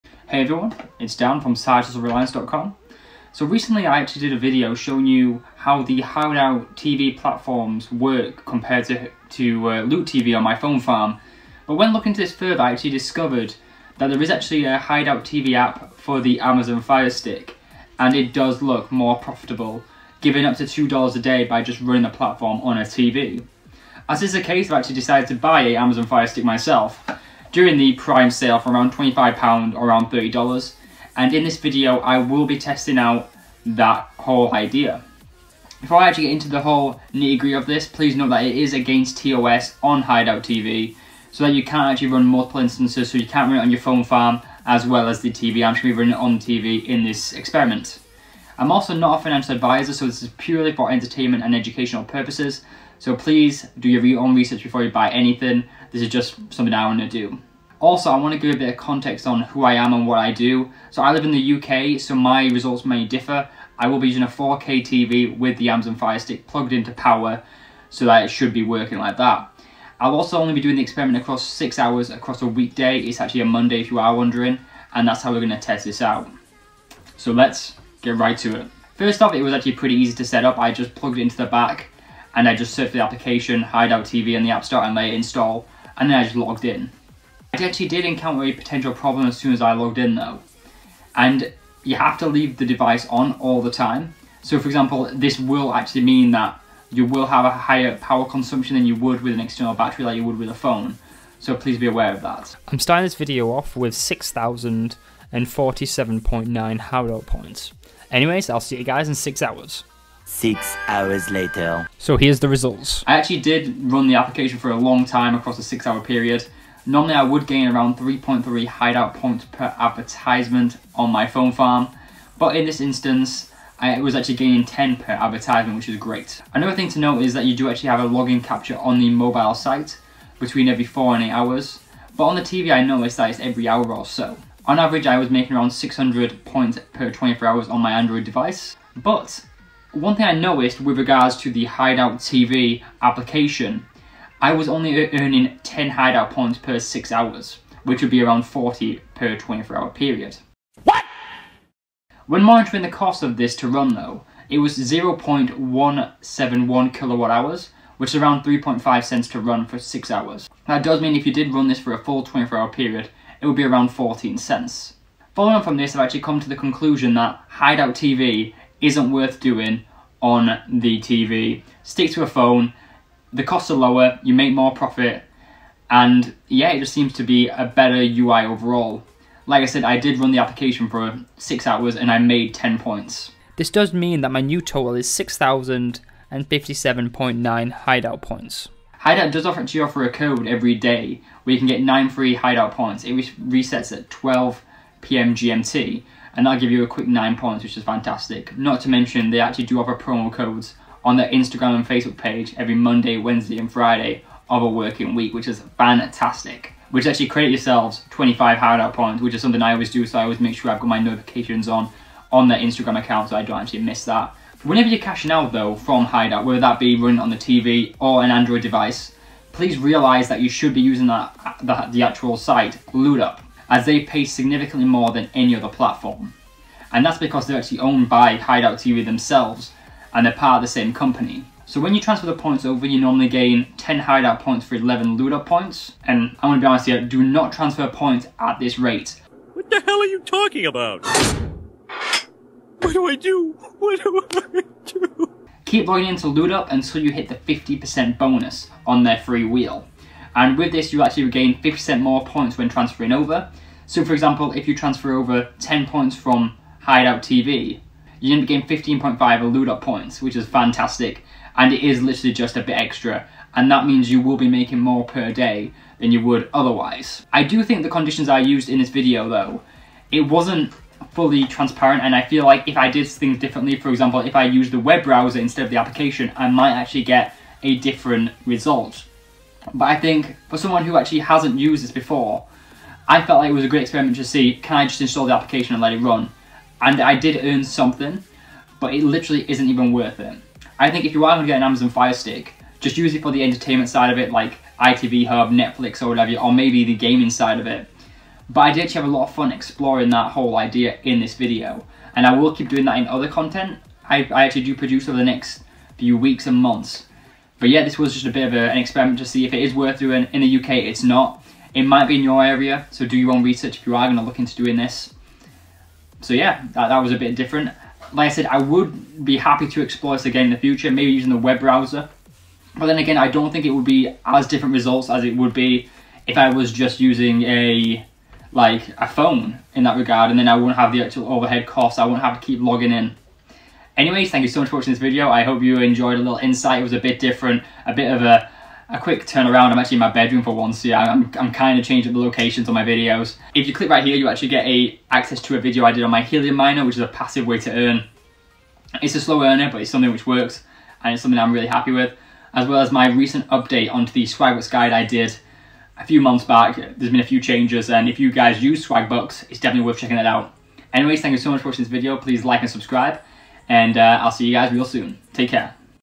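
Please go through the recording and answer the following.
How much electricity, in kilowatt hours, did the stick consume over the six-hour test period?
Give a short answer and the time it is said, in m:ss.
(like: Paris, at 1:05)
0.171, at 2:34.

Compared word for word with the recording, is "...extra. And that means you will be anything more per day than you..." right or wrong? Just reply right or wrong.
wrong.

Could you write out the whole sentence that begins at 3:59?
What the hell are you talking about?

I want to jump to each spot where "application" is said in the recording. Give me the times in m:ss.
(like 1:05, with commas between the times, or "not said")
1:23, 1:54, 2:23, 3:00, 4:35, 4:45.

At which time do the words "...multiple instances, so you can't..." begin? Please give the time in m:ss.
0:42.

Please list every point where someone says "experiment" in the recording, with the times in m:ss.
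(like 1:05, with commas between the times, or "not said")
0:47, 1:10, 4:43, 5:08.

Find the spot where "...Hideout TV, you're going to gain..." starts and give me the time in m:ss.
4:16.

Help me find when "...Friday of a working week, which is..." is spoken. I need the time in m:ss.
3:23.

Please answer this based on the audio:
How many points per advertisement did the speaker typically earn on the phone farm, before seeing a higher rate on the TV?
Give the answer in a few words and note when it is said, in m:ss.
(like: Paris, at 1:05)
3.3, at 1:57.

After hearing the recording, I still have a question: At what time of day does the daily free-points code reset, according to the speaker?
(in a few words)
12 p.m. GMT.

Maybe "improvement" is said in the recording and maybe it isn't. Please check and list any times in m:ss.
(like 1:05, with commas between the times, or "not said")
not said.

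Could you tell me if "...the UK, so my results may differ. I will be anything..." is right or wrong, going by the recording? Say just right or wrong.
wrong.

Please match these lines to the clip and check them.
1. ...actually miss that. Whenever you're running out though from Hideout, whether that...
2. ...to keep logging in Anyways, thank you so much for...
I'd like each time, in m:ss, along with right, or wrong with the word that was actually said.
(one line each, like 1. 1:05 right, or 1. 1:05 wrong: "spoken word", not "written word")
1. 3:33 wrong: "cashing", not "running"
2. 5:32 right.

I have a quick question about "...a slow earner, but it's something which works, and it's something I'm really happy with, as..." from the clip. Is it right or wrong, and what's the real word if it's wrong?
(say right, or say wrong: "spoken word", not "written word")
right.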